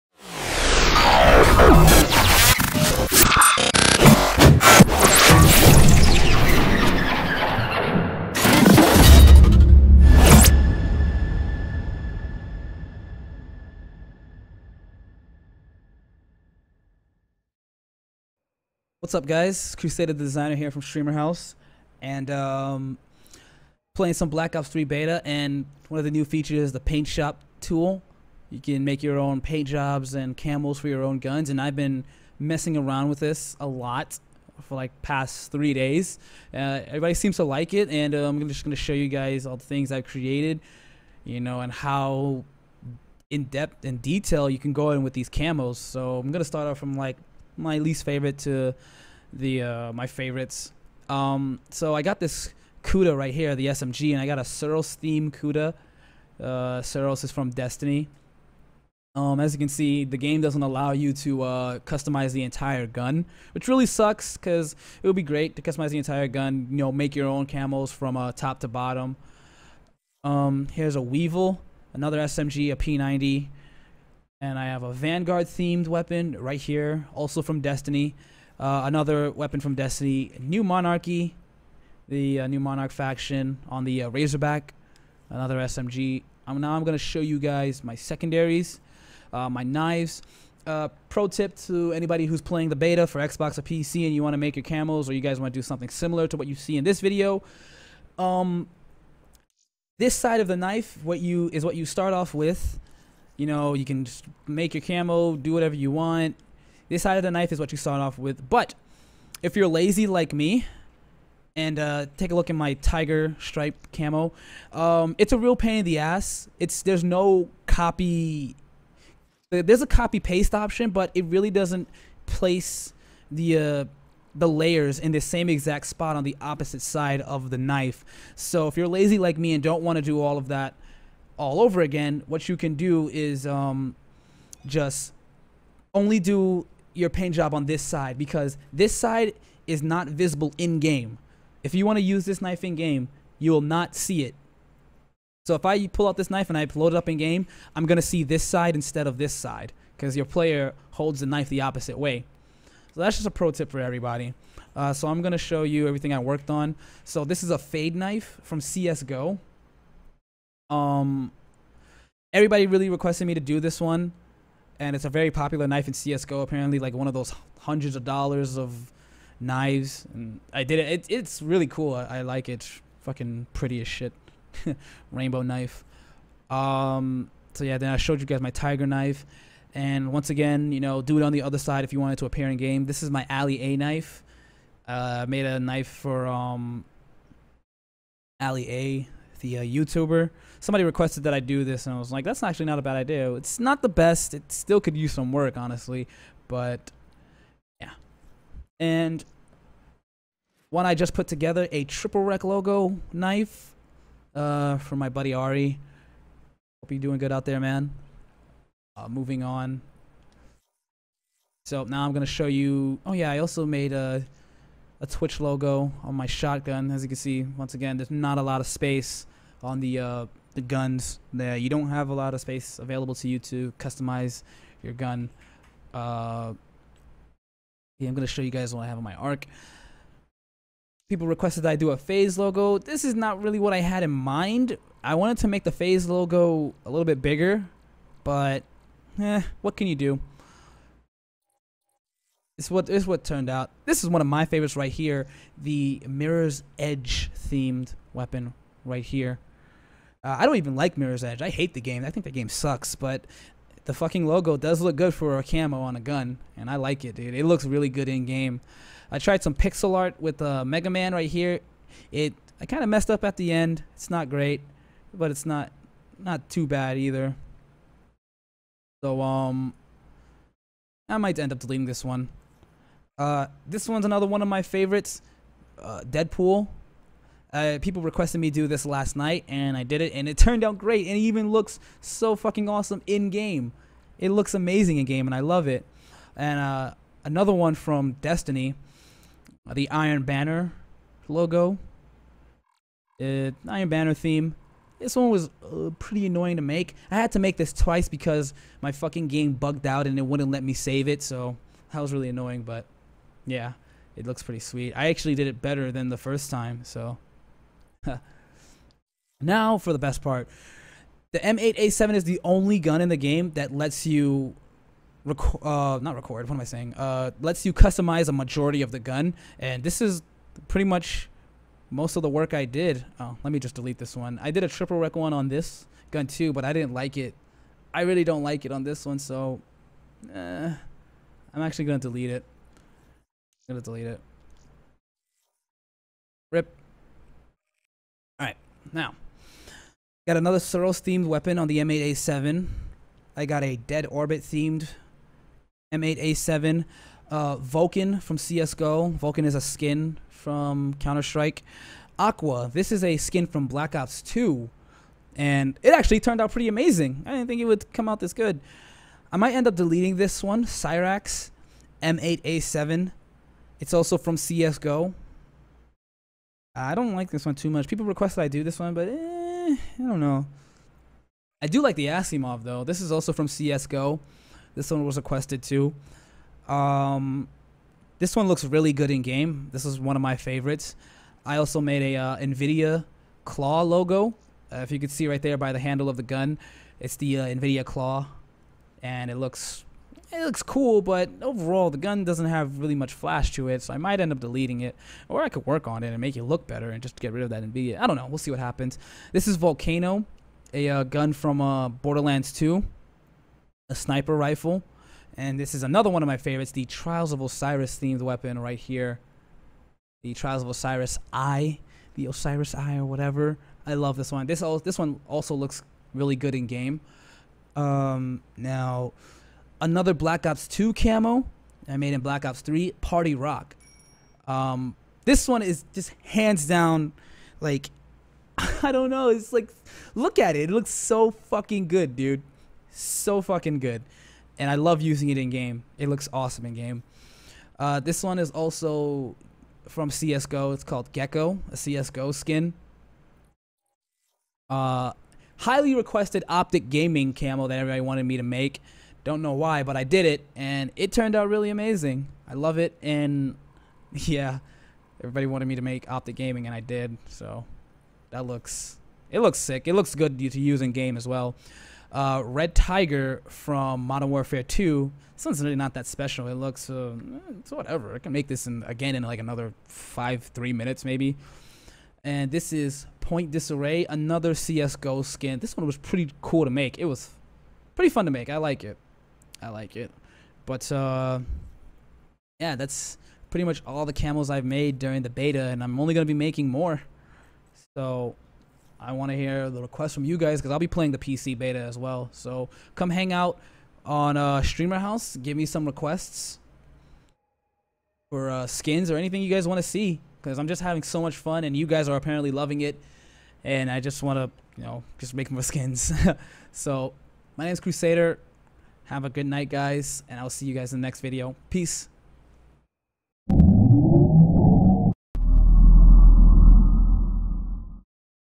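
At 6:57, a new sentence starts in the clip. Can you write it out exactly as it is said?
Um, now, another Black Ops 2 camo I made in Black Ops 3, Party Rock.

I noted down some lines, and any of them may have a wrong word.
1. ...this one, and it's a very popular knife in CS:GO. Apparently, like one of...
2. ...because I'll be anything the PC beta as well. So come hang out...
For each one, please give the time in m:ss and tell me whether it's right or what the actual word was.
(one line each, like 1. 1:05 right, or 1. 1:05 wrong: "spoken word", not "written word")
1. 2:43 right
2. 8:10 wrong: "playing", not "anything".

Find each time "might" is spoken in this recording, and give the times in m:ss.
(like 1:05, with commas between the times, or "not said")
4:31, 5:59, 6:33.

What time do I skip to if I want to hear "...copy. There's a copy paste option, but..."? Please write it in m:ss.
1:57.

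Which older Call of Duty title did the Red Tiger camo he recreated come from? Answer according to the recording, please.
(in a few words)
Modern Warfare 2.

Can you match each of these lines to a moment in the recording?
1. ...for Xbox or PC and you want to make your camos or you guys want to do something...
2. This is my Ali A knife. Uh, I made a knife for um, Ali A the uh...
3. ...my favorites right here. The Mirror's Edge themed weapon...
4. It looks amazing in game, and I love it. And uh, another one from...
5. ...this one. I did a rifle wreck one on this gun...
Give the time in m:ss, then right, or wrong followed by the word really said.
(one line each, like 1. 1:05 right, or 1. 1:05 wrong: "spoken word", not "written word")
1. 1:33 right
2. 3:02 right
3. 4:04 right
4. 4:44 right
5. 5:23 wrong: "triple", not "rifle".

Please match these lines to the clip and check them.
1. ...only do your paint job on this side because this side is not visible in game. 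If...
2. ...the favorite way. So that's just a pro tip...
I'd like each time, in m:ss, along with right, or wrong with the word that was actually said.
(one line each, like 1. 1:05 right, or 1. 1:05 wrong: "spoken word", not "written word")
1. 2:15 right
2. 2:31 wrong: "opposite", not "favorite".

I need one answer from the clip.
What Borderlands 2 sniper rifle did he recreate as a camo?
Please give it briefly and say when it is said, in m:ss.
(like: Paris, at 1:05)
Volcano, at 6:39.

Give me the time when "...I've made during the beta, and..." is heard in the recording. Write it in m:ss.
8:04.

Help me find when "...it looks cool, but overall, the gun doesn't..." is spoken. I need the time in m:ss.
6:30.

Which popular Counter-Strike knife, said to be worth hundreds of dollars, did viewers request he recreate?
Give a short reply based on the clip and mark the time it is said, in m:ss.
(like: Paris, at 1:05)
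Fade knife, at 2:37.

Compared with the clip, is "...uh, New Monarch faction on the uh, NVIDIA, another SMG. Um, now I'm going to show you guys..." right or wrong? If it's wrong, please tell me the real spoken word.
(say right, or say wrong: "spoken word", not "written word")
wrong: "Razorback", not "NVIDIA".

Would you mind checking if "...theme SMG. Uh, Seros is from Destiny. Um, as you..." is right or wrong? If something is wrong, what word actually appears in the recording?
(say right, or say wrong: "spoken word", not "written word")
wrong: "Kuda", not "SMG".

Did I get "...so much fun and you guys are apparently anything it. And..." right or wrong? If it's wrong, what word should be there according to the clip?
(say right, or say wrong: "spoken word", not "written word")
wrong: "loving", not "anything".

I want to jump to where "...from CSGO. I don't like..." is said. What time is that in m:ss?
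6:04.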